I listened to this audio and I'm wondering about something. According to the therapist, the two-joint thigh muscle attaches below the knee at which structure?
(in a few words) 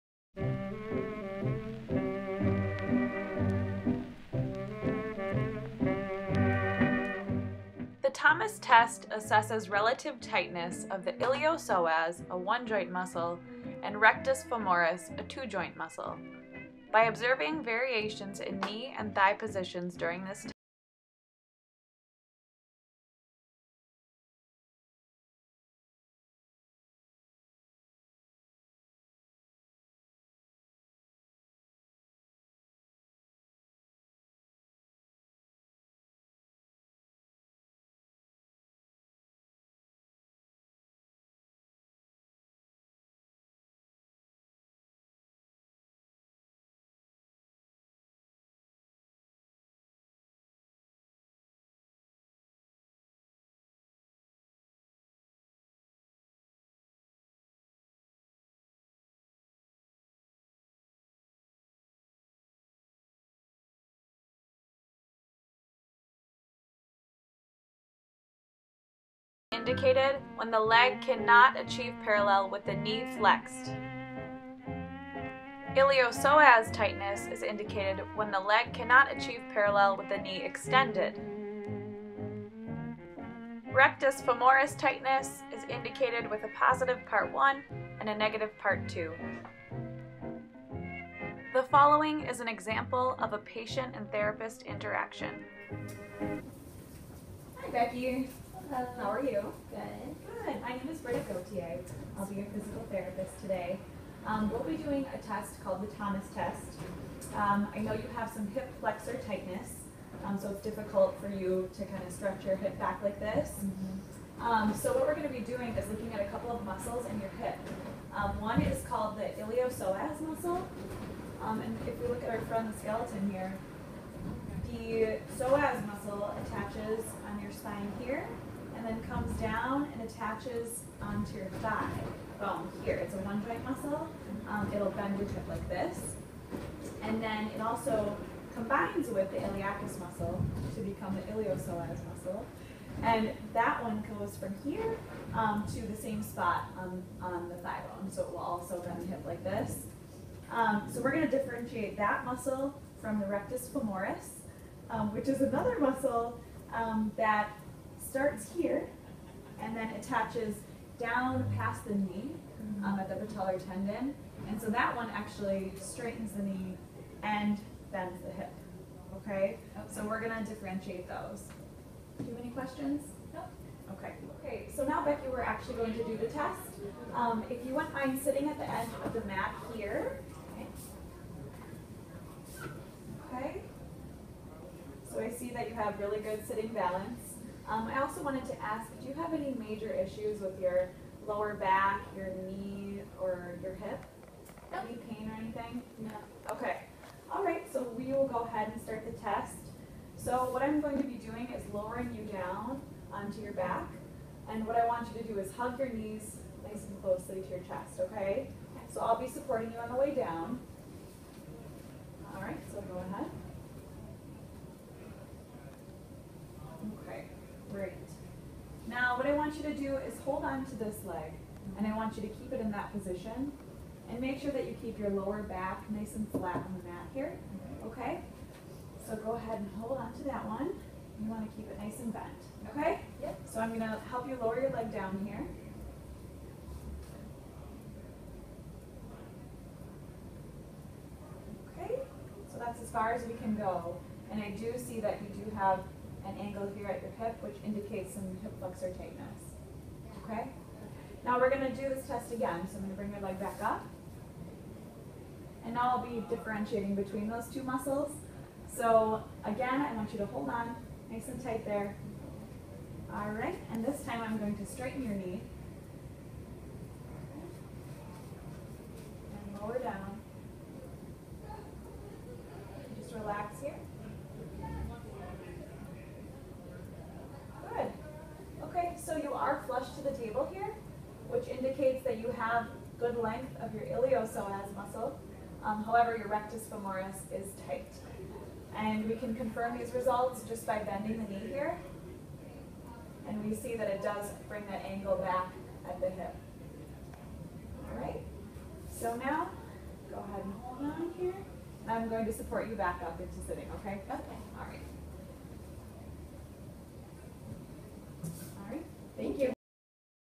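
patellar tendon.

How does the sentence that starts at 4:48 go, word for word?
And we can confirm these results just by bending the knee here.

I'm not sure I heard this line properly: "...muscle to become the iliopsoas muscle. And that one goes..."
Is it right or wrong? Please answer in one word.
right.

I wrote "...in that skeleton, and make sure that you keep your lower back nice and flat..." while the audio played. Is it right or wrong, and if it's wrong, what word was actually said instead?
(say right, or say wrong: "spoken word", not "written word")
wrong: "position", not "skeleton".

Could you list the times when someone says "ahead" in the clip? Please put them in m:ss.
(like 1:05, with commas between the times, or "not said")
3:18, 3:33, 3:49, 5:00.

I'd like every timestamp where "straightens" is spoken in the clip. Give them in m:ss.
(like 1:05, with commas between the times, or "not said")
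2:45, 4:24.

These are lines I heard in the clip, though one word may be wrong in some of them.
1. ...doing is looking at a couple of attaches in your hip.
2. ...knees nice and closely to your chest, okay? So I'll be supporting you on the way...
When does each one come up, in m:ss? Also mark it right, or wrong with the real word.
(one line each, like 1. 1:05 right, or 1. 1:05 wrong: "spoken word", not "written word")
1. 1:55 wrong: "muscles", not "attaches"
2. 3:25 right.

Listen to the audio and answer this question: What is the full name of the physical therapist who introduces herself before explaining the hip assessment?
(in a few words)
Britta Gautier.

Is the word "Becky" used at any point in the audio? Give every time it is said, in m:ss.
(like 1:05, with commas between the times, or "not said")
1:37, 2:55.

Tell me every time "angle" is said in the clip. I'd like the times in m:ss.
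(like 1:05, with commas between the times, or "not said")
4:06, 4:54.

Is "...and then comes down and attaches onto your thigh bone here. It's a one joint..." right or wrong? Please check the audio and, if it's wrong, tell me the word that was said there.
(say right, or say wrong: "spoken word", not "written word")
right.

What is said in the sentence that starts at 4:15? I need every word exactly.
And now I'll be differentiating between those two muscles.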